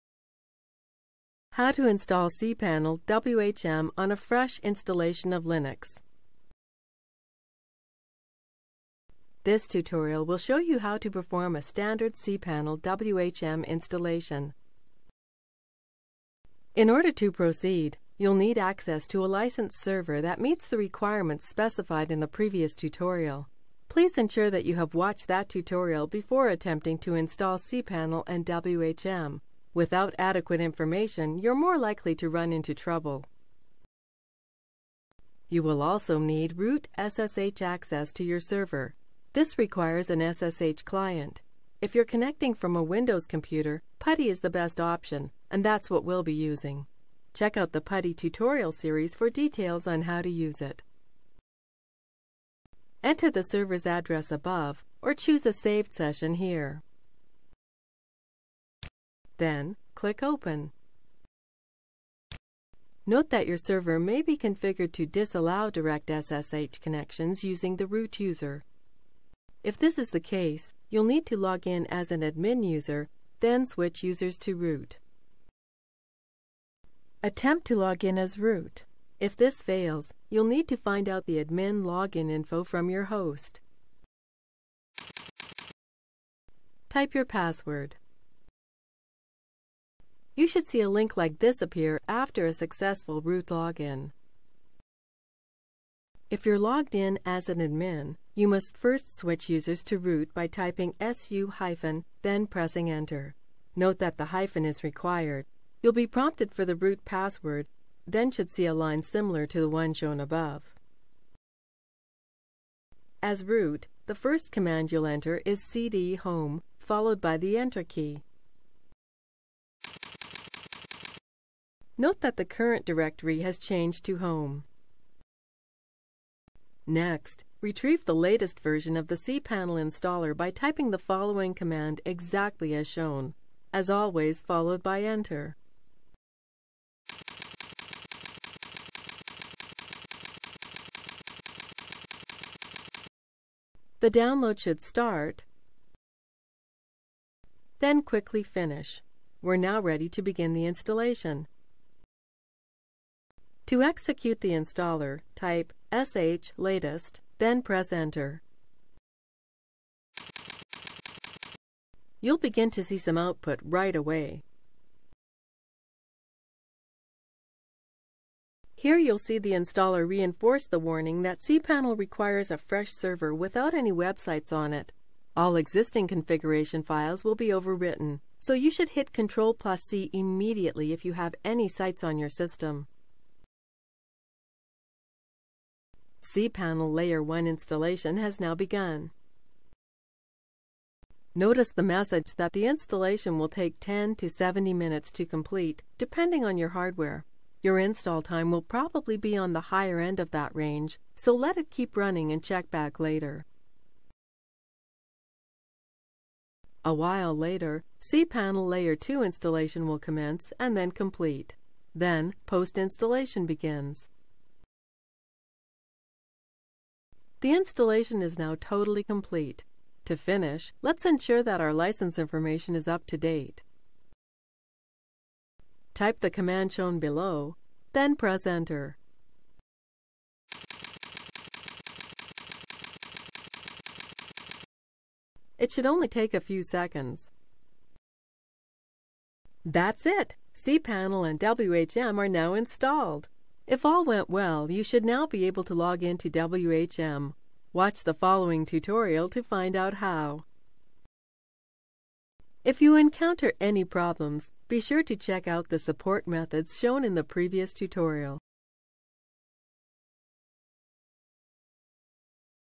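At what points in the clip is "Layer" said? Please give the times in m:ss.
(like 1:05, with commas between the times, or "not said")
3:06, 3:28.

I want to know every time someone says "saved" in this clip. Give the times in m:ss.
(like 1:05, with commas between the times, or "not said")
0:55.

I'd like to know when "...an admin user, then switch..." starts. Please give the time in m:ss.
1:12.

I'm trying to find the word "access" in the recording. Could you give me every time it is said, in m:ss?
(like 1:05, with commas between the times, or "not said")
0:18, 0:37.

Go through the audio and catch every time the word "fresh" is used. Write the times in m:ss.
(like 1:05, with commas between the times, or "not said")
0:04, 2:52.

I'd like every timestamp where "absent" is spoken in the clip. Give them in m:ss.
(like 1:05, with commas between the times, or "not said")
not said.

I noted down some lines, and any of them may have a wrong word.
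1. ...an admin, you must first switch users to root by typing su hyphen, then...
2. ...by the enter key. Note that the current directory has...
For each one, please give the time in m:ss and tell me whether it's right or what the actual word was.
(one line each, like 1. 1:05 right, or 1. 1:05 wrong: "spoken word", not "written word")
1. 1:37 right
2. 1:57 right.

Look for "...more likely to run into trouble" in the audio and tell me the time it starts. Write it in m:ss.
0:31.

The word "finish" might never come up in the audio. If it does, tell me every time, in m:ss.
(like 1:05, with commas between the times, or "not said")
2:28, 3:40.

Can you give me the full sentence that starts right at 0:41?
If you're connecting from a Windows computer, PuTTY is the best option, and that's what we'll be using.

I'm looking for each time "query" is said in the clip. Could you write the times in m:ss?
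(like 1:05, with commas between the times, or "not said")
not said.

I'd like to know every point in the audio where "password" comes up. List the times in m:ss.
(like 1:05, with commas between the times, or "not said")
1:27, 1:47.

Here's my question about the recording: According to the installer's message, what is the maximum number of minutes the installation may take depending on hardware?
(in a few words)
70.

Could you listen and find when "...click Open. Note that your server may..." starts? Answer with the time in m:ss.
0:59.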